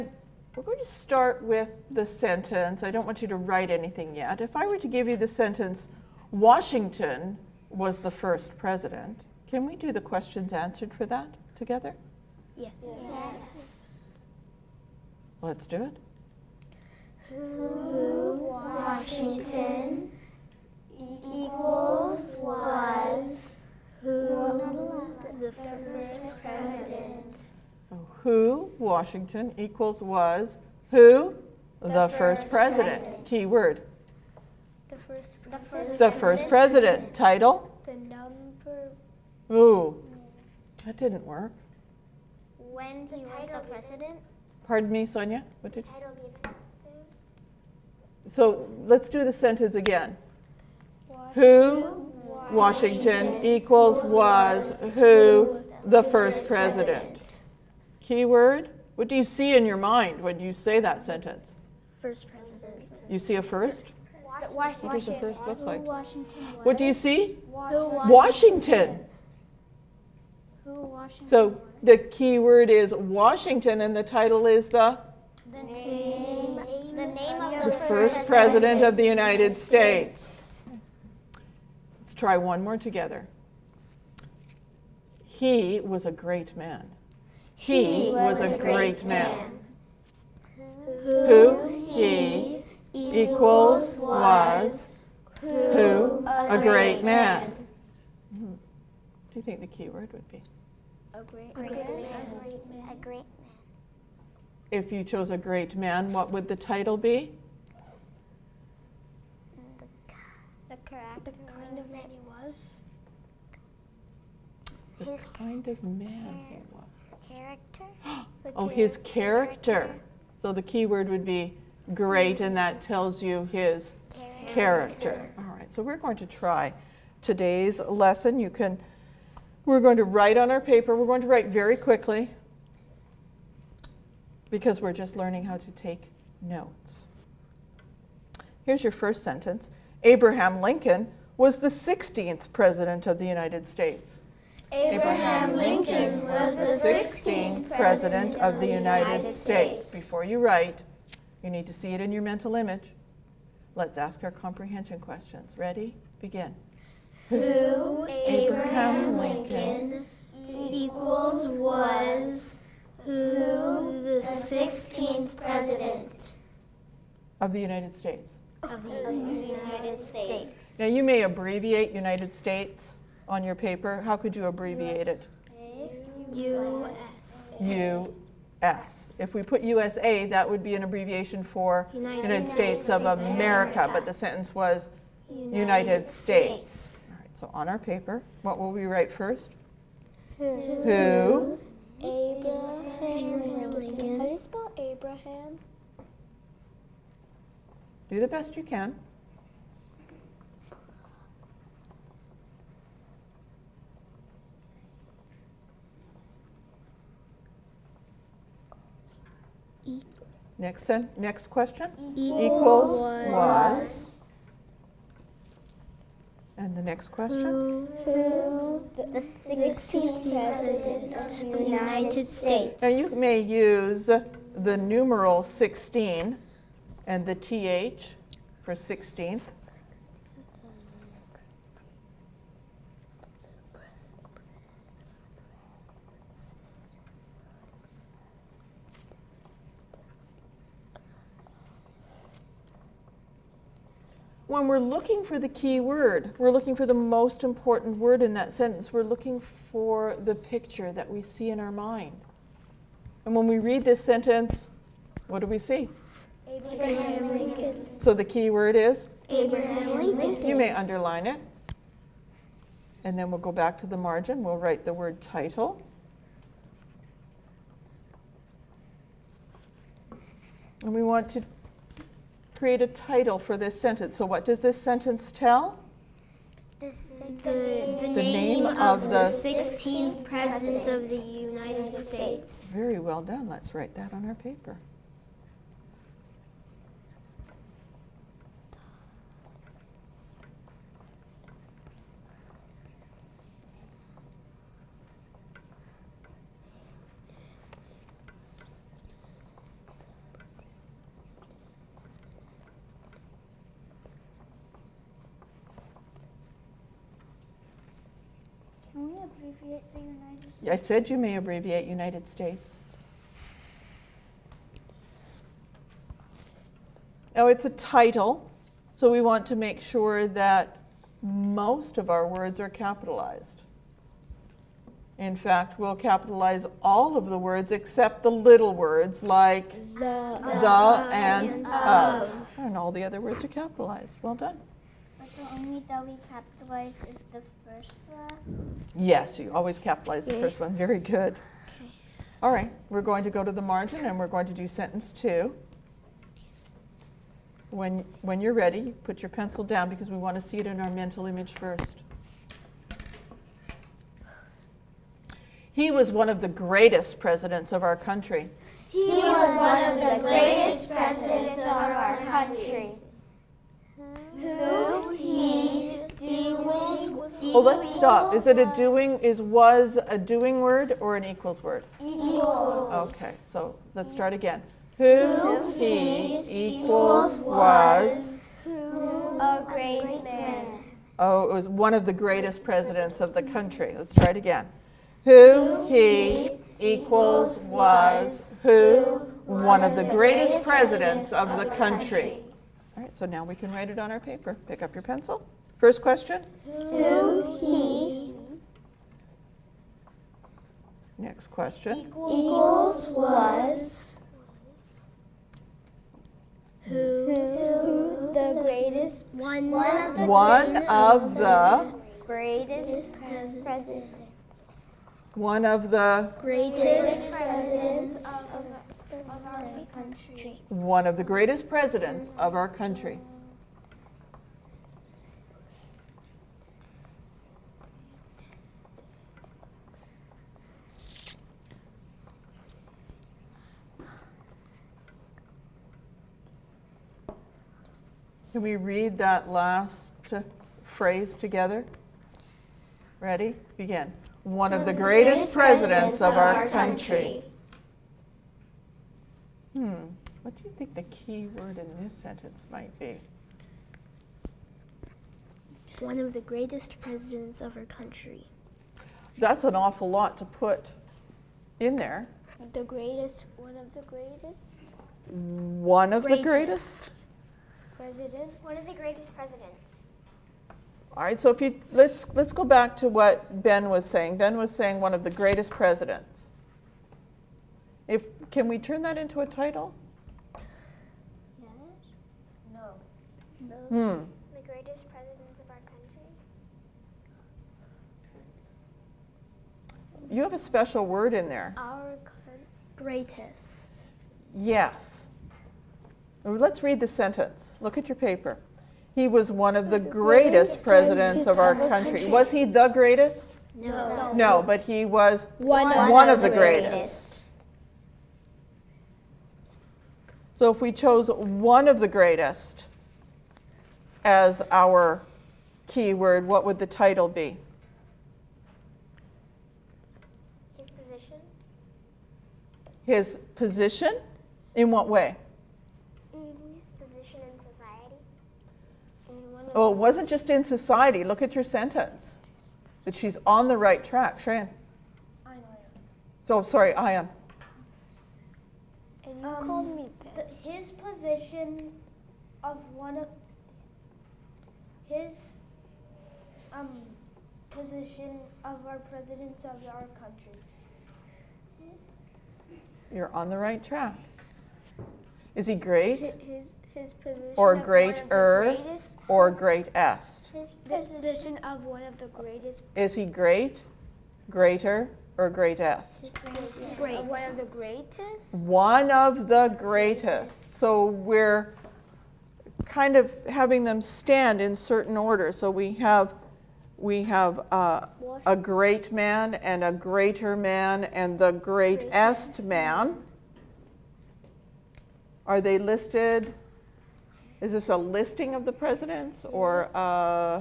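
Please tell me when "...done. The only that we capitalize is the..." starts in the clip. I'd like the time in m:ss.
5:34.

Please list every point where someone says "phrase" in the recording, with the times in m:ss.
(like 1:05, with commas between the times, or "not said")
7:20.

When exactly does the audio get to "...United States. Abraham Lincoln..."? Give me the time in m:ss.
2:23.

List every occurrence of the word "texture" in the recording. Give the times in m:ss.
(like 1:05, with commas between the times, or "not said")
not said.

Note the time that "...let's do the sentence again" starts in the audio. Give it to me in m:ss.
0:48.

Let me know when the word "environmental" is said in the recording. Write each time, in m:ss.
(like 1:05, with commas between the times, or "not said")
not said.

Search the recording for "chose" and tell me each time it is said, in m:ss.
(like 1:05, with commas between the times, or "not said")
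1:45, 8:30.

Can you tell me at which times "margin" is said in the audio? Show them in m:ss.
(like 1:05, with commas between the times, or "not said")
4:23, 5:43.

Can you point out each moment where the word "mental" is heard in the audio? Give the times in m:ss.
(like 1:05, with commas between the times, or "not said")
2:32, 5:50.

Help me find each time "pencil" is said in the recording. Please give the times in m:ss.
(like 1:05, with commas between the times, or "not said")
5:49, 6:35.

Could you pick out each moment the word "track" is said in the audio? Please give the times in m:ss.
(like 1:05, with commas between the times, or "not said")
8:54, 9:13.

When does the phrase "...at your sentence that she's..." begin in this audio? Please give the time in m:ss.
8:51.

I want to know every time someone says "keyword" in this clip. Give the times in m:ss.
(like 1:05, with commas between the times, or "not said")
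0:57, 8:35.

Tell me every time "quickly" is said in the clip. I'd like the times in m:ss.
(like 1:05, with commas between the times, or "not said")
2:11.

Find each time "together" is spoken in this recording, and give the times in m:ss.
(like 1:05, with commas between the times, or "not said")
0:11, 1:22, 7:21.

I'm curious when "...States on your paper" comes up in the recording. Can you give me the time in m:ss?
2:52.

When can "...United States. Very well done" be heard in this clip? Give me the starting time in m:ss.
4:41.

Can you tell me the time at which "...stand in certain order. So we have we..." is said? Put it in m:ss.
9:34.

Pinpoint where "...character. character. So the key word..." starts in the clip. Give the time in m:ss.
1:59.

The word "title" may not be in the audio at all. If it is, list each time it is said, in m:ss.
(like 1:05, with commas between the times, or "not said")
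0:37, 1:14, 1:46, 4:25, 4:32, 5:17, 7:59, 8:36.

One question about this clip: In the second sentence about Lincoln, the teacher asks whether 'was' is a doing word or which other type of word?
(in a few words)
equals word.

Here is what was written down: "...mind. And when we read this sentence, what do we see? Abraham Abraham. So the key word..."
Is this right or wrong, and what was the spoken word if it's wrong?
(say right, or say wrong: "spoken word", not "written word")
wrong: "Lincoln", not "Abraham".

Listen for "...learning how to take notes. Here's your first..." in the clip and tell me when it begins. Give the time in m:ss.
2:15.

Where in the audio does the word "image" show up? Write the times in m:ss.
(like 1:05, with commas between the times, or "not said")
2:32, 5:51.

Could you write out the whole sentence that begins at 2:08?
You can we're going to write on our paper.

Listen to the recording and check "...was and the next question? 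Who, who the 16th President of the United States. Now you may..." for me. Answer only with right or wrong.
right.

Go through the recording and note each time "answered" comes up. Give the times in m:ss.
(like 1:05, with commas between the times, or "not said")
0:10.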